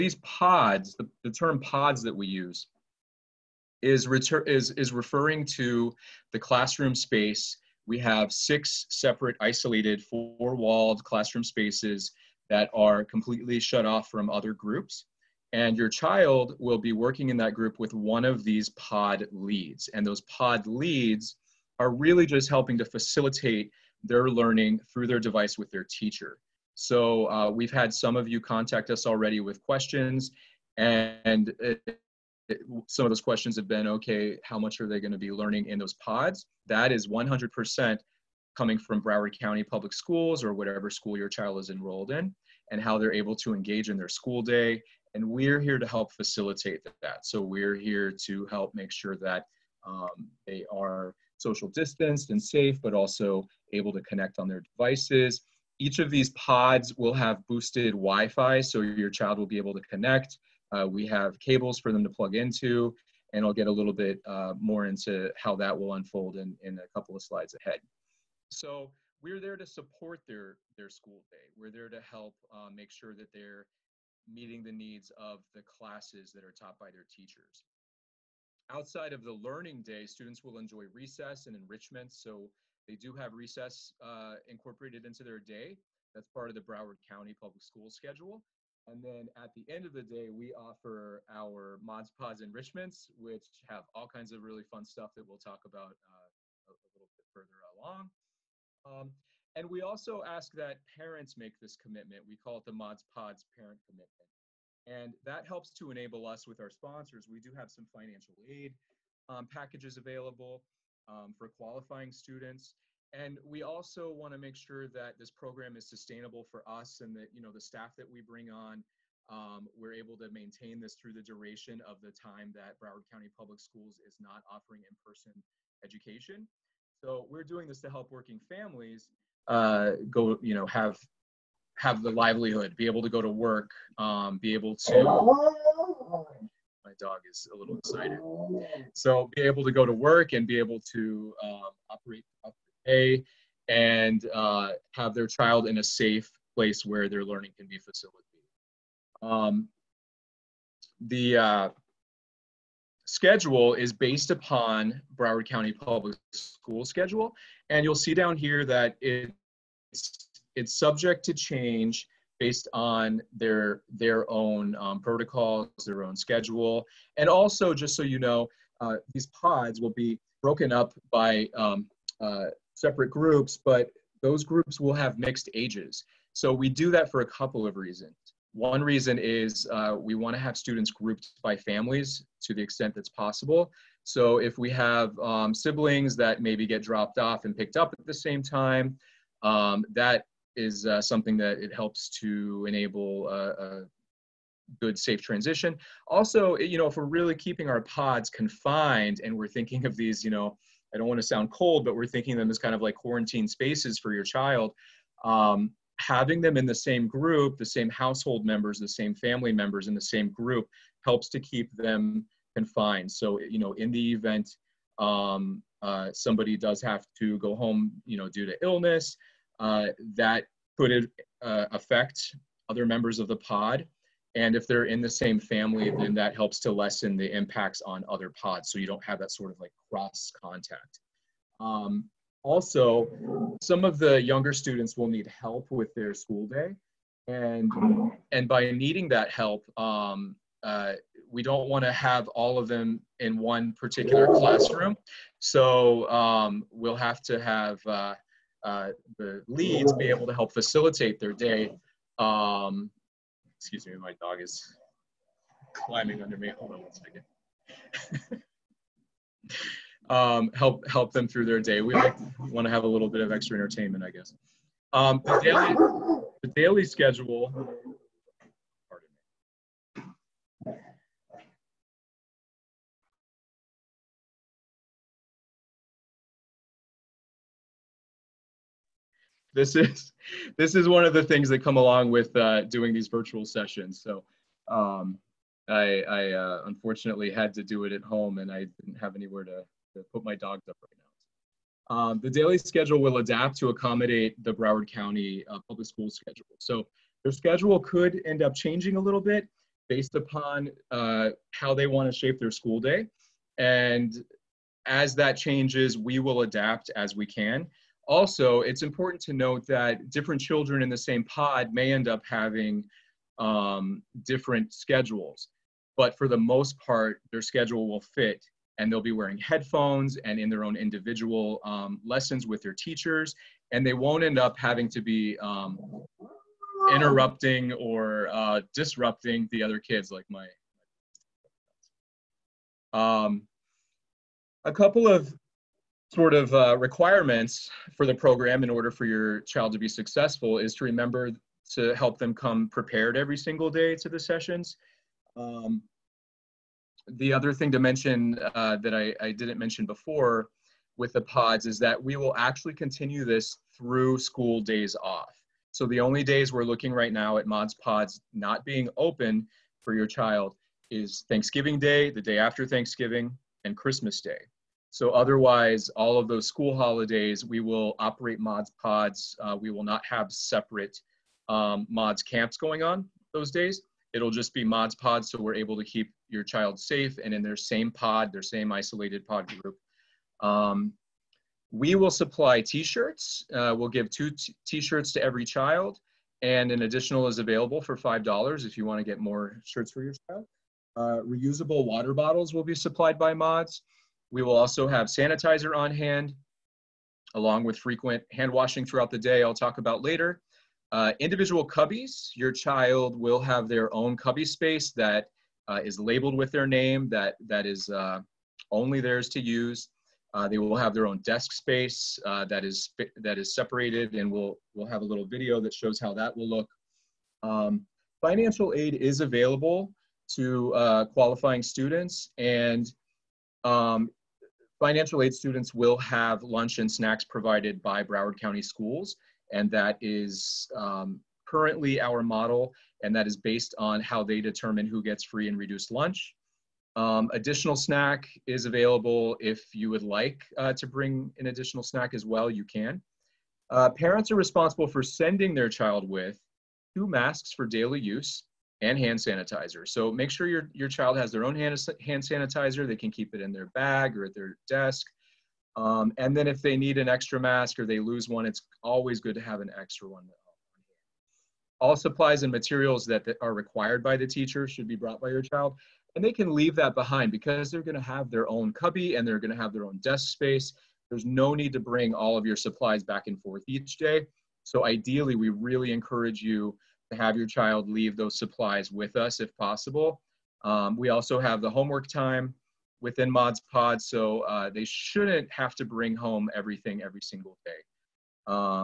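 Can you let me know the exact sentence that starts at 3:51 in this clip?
Um, also, some of the younger students will need help with their school day.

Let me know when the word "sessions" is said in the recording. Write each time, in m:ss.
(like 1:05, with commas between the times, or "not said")
4:43, 5:44.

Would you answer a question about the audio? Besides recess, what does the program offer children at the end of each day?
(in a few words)
Mods Pods enrichments.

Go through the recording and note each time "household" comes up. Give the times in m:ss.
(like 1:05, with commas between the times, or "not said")
3:27.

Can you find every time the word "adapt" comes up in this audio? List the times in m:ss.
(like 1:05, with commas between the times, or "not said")
4:53, 5:06.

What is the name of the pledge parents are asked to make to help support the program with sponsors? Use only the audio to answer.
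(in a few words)
Mods Pods parent commitment.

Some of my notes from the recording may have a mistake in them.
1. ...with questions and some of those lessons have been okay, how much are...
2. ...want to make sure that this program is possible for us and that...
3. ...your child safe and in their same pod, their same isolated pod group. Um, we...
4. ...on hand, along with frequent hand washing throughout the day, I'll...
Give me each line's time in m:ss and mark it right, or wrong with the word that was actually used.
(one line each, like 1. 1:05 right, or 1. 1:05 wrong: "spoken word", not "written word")
1. 0:29 wrong: "questions", not "lessons"
2. 1:54 wrong: "sustainable", not "possible"
3. 6:16 right
4. 6:35 right.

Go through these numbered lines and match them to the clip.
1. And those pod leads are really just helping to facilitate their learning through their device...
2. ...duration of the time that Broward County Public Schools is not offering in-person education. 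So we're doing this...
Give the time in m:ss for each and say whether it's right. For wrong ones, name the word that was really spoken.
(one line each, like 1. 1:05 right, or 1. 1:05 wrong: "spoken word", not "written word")
1. 0:19 right
2. 2:01 right.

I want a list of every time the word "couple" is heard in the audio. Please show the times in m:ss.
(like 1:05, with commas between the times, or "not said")
1:06, 2:57, 5:34.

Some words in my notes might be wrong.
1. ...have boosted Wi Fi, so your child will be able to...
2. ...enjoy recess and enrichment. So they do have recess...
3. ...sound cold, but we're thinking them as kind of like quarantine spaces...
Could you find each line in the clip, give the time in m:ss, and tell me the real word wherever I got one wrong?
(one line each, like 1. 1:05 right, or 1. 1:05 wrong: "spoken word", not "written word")
1. 0:57 right
2. 1:20 right
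3. 3:21 right.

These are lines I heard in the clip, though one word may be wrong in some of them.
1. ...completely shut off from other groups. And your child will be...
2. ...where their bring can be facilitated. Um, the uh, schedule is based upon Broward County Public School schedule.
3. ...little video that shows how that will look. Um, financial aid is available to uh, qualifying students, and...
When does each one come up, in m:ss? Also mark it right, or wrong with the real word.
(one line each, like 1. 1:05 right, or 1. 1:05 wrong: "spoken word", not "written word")
1. 0:13 right
2. 2:26 wrong: "learning", not "bring"
3. 6:55 right.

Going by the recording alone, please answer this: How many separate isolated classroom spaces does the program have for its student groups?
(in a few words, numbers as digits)
6.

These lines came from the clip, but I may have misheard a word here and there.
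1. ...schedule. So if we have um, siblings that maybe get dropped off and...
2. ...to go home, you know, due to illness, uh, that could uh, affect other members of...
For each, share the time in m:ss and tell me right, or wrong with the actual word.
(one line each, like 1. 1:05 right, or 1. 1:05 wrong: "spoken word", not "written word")
1. 3:03 wrong: "possible", not "schedule"
2. 3:37 right.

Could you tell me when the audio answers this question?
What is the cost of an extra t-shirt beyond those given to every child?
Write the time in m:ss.
6:27.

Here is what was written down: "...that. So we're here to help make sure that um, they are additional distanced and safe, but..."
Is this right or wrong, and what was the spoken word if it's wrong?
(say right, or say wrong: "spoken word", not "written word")
wrong: "social", not "additional".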